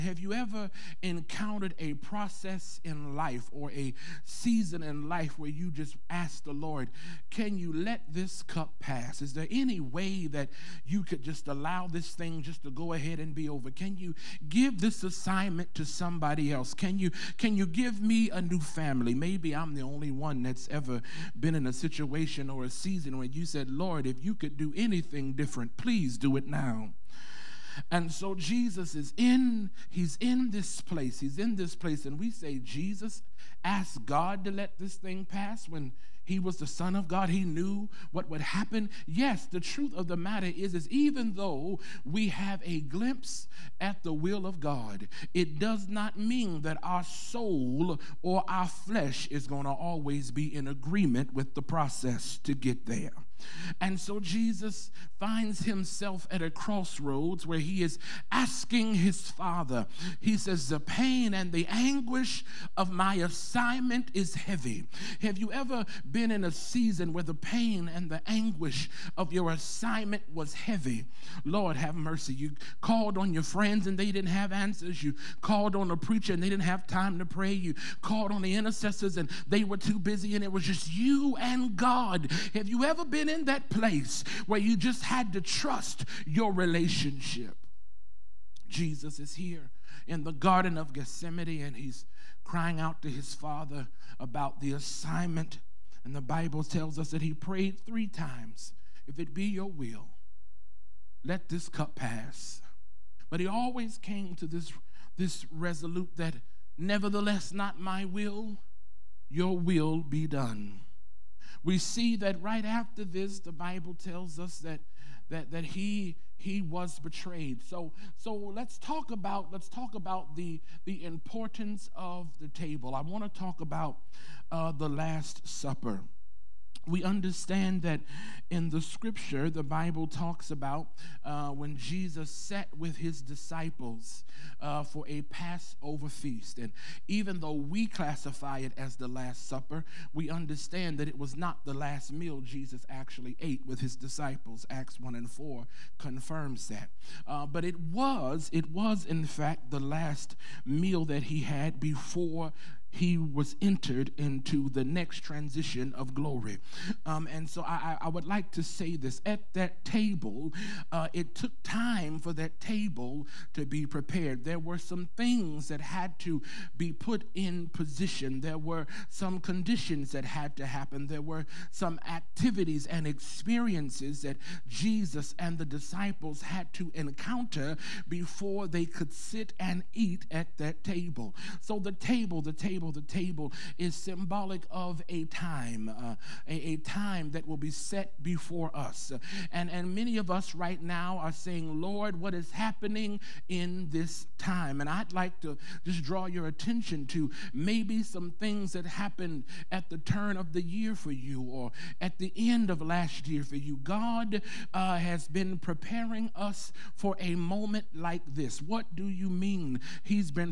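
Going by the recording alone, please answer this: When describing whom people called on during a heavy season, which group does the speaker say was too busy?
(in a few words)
The intercessors.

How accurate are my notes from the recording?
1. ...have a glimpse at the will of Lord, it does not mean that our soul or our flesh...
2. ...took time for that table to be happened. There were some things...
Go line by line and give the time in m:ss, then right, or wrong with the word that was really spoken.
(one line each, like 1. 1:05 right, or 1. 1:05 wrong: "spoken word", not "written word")
1. 0:42 wrong: "God", not "Lord"
2. 2:41 wrong: "prepared", not "happened".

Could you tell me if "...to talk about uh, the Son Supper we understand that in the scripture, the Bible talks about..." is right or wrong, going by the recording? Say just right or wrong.
wrong.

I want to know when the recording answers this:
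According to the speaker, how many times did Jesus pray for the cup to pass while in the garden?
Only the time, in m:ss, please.
1:37.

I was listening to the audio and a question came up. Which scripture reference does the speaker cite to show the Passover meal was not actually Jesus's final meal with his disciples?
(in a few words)
Acts 1:4.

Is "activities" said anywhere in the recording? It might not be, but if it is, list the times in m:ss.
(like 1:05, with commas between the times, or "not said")
2:52.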